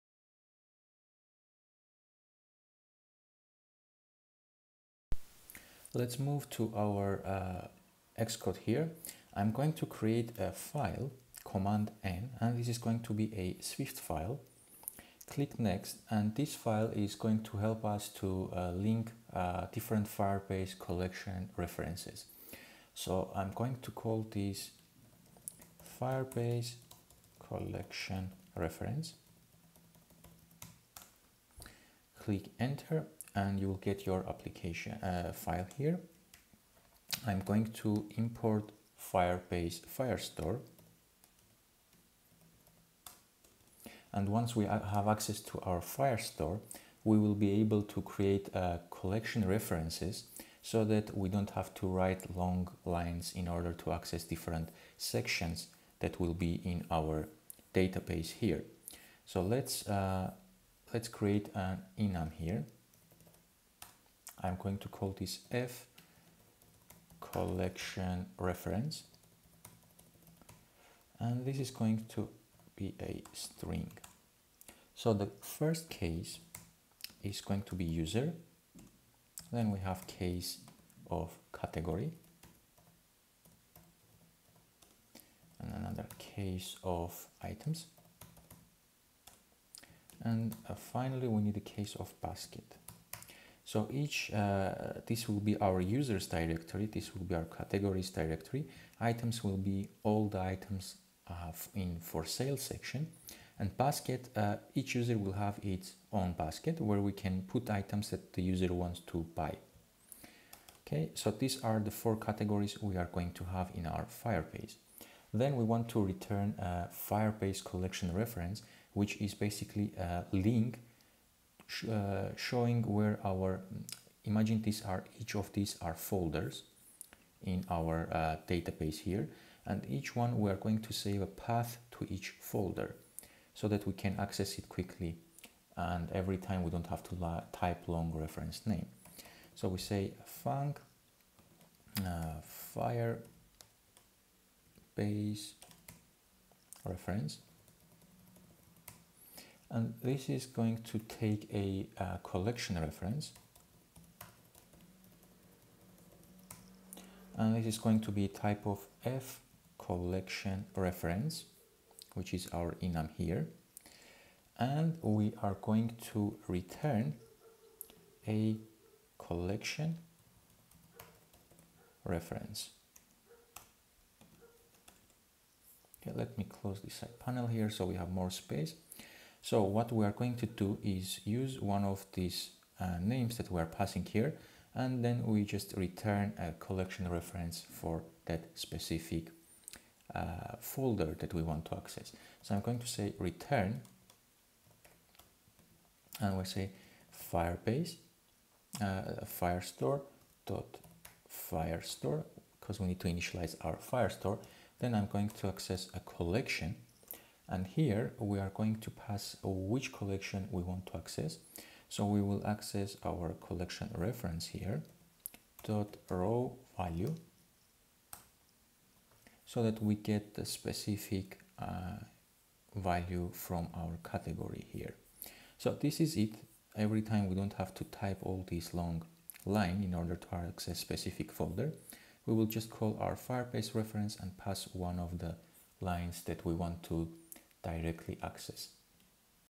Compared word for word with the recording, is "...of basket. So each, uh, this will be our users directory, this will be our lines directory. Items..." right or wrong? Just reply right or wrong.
wrong.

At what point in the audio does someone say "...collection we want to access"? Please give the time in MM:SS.
03:29.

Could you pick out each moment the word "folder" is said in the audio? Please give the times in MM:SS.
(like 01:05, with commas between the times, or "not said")
02:05, 02:12, 03:10, 03:51.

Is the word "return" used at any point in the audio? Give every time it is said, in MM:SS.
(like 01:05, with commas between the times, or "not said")
01:56, 02:46, 03:05, 03:13.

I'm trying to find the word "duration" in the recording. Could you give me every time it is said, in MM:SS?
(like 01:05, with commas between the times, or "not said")
not said.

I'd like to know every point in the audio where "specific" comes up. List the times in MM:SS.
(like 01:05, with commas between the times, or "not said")
03:08, 03:40, 03:50.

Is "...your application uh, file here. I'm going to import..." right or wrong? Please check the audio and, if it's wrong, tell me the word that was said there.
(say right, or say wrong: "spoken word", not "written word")
right.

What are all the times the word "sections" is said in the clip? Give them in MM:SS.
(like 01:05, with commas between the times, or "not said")
00:54, 01:42.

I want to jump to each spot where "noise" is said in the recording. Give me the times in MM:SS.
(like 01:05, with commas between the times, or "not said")
not said.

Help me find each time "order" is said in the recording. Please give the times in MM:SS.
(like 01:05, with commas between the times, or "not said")
00:53, 03:49.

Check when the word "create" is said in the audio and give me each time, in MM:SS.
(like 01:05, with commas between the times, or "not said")
00:09, 00:48, 01:01.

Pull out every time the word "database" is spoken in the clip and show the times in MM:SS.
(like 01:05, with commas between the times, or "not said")
00:57, 02:08.